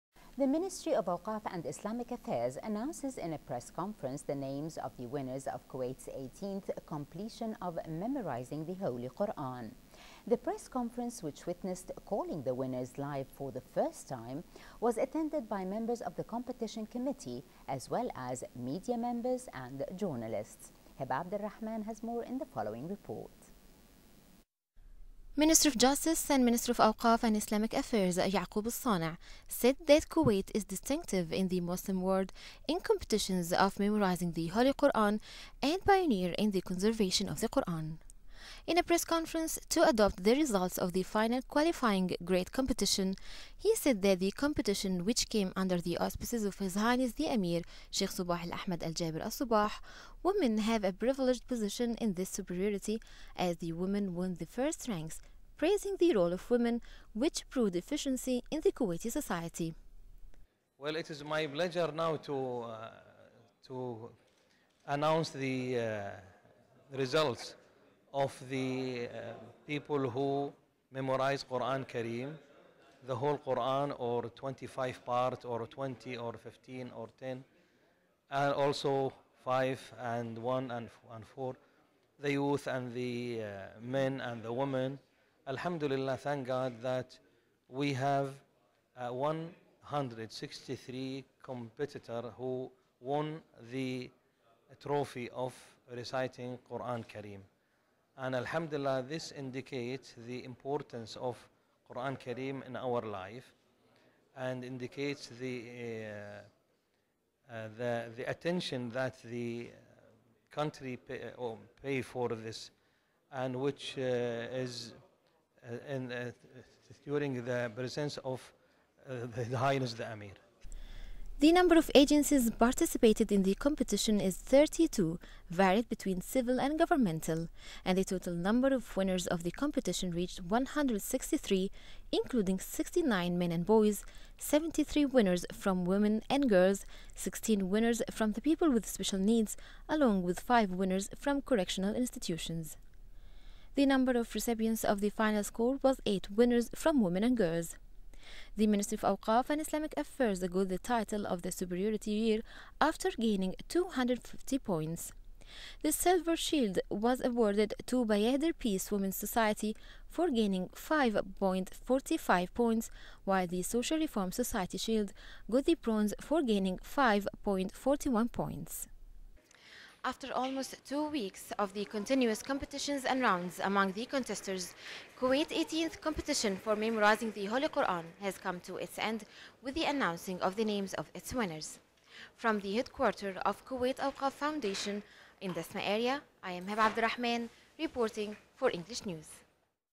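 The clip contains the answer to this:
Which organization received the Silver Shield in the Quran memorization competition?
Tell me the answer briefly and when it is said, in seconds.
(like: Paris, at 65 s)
Bayader Peace Women's Society, at 158 s.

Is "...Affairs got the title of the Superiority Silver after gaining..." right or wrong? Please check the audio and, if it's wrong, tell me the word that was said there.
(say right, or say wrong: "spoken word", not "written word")
wrong: "Year", not "Silver".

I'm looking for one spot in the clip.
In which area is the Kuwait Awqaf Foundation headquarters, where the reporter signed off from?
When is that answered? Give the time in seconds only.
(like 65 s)
185 s.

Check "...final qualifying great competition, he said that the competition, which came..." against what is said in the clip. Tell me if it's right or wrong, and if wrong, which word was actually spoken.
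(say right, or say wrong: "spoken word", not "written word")
right.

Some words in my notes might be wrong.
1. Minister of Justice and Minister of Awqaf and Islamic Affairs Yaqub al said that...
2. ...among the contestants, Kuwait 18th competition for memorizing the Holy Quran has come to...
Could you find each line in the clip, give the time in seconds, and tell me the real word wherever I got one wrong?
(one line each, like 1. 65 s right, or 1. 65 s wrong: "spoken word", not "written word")
1. 25 s right
2. 173 s right.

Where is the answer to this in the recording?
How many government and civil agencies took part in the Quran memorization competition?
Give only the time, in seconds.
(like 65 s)
124 s.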